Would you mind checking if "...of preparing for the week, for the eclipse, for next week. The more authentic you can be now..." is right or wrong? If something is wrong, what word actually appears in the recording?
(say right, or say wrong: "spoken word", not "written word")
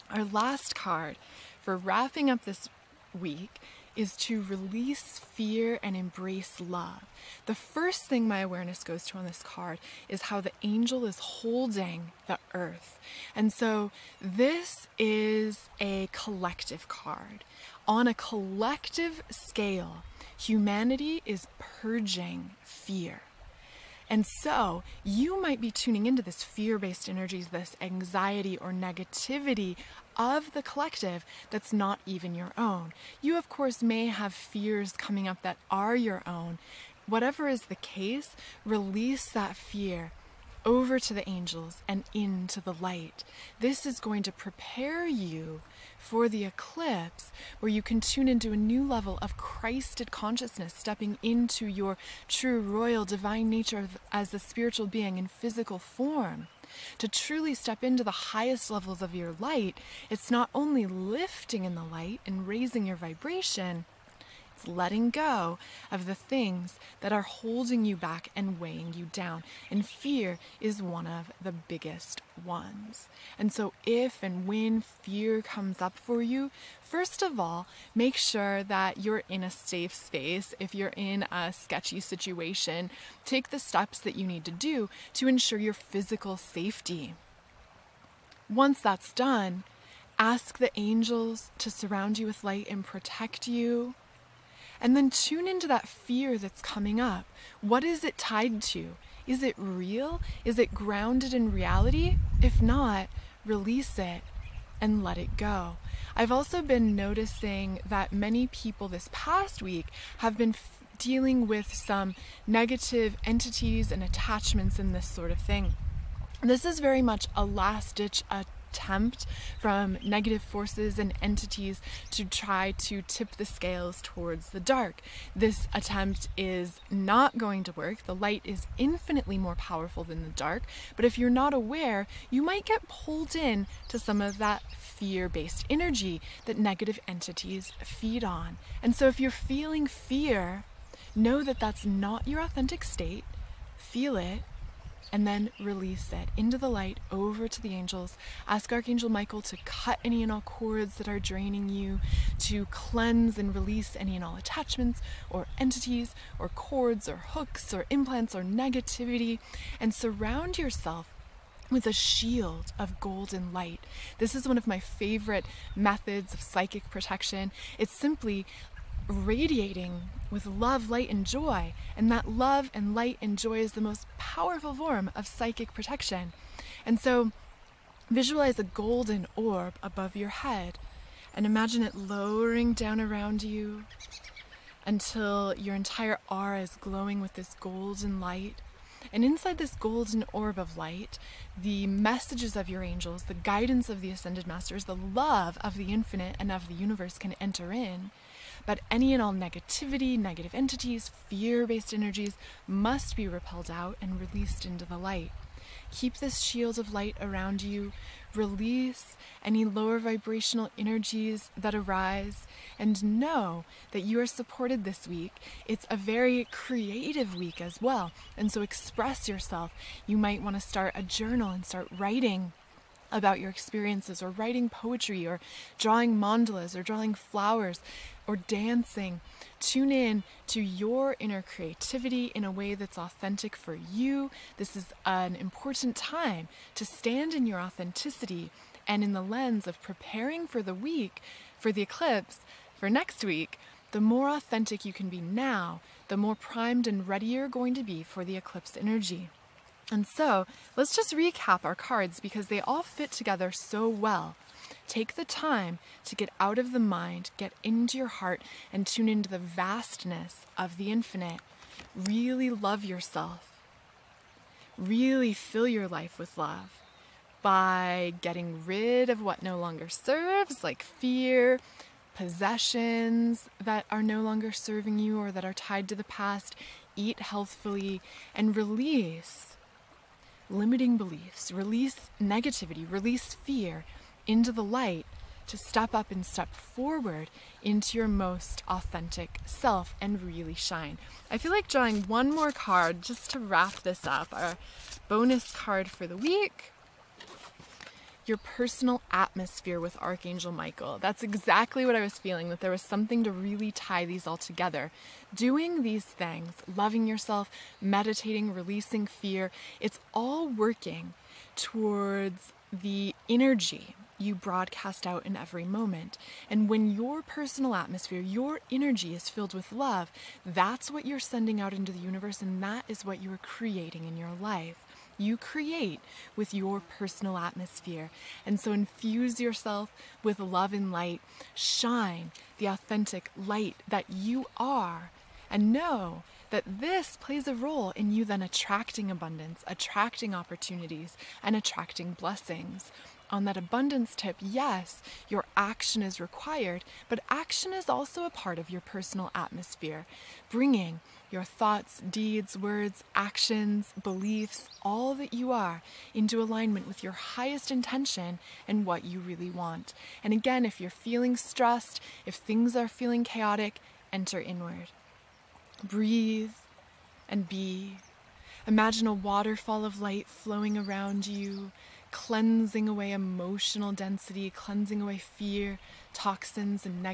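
right.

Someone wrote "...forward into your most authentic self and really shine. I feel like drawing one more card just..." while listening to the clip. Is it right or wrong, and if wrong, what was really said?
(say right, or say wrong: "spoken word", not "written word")
right.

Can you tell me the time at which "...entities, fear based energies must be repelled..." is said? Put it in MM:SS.
03:20.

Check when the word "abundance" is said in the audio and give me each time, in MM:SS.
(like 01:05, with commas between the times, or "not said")
05:39, 05:43.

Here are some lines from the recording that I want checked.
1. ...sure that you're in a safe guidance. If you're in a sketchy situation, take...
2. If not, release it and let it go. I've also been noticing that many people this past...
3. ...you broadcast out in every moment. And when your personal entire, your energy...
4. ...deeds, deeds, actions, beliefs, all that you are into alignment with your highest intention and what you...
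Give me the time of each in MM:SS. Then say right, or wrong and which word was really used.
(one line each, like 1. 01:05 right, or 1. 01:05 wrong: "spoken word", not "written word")
1. 01:18 wrong: "space", not "guidance"
2. 01:42 right
3. 05:14 wrong: "atmosphere", not "entire"
4. 05:52 wrong: "words", not "deeds".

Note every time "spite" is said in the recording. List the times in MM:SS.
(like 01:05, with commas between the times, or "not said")
not said.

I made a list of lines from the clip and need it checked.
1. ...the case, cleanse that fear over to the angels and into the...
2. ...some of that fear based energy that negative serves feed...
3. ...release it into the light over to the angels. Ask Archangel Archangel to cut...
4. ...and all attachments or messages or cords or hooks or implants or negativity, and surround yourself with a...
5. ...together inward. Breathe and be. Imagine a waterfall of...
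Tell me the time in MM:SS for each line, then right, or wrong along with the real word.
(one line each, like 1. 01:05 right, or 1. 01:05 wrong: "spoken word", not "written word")
1. 00:37 wrong: "release", not "cleanse"
2. 02:13 wrong: "entities", not "serves"
3. 02:25 wrong: "Michael", not "Archangel"
4. 02:34 wrong: "entities", not "messages"
5. 06:04 wrong: "enter", not "together".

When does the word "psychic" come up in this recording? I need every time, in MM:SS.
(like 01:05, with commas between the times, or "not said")
02:46, 02:55.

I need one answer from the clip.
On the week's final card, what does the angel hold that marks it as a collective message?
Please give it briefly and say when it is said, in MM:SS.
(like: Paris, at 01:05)
the earth, at 00:12.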